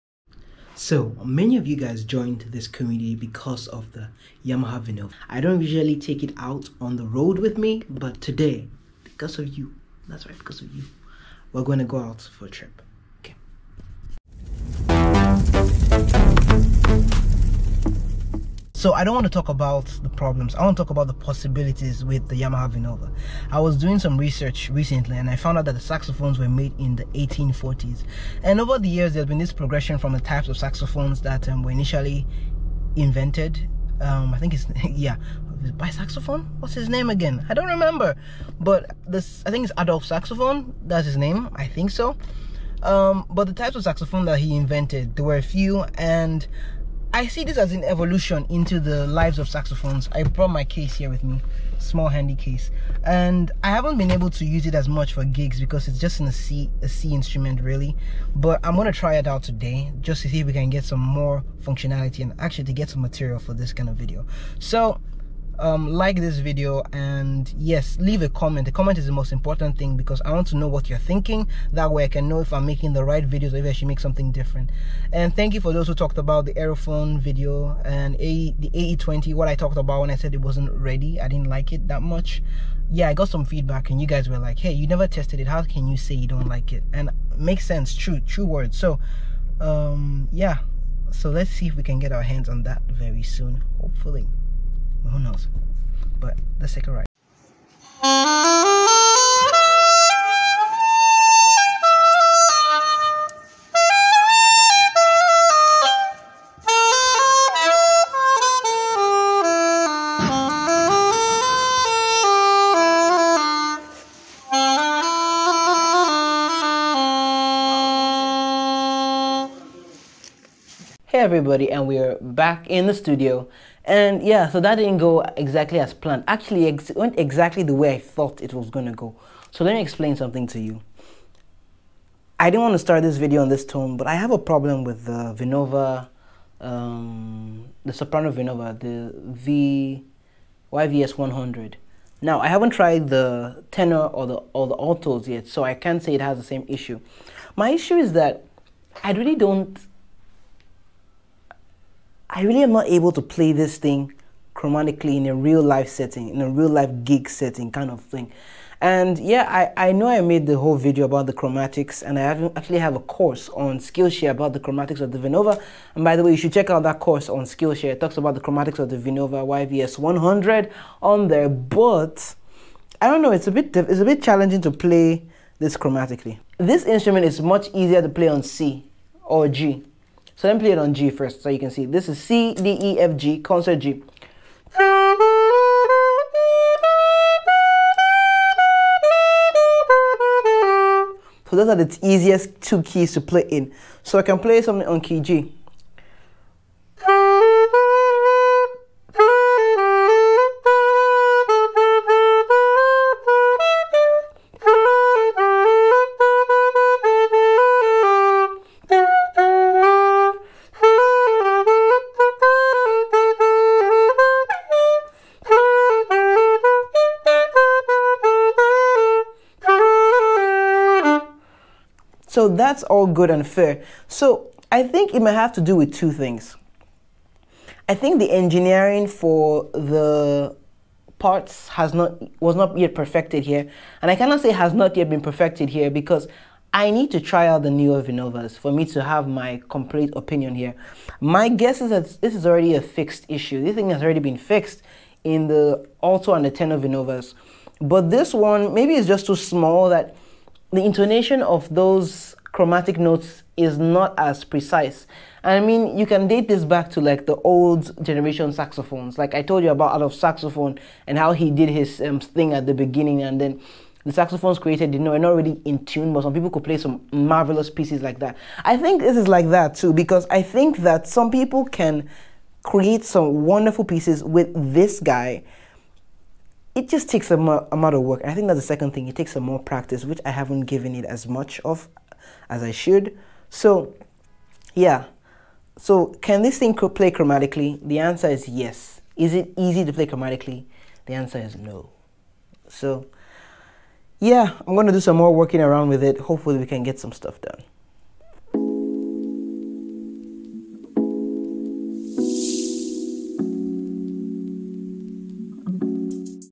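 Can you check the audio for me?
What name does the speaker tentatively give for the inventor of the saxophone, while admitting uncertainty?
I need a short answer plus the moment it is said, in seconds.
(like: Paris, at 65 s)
Adolf Saxophone, at 39 s.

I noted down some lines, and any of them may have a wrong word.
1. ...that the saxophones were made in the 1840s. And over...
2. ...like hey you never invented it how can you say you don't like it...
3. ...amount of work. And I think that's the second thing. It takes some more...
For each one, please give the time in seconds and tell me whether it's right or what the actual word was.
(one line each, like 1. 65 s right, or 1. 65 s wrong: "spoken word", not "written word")
1. 25 s right
2. 84 s wrong: "tested", not "invented"
3. 277 s right.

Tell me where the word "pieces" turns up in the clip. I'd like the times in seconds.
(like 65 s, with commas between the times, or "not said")
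267 s, 273 s.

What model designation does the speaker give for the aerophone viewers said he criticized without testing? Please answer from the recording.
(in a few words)
AE20.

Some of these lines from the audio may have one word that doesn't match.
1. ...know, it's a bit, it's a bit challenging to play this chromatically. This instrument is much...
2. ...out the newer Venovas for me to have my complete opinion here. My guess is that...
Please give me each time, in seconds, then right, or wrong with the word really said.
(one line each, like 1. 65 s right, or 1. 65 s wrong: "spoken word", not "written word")
1. 173 s right
2. 237 s right.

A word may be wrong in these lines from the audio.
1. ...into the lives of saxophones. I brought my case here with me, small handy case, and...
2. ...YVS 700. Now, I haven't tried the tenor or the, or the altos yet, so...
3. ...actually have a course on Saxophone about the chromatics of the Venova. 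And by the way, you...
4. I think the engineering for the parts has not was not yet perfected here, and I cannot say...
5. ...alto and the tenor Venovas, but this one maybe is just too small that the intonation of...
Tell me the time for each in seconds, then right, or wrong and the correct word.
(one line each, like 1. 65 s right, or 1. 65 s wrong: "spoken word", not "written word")
1. 48 s right
2. 140 s wrong: "100", not "700"
3. 162 s wrong: "Skillshare", not "Saxophone"
4. 227 s right
5. 246 s right.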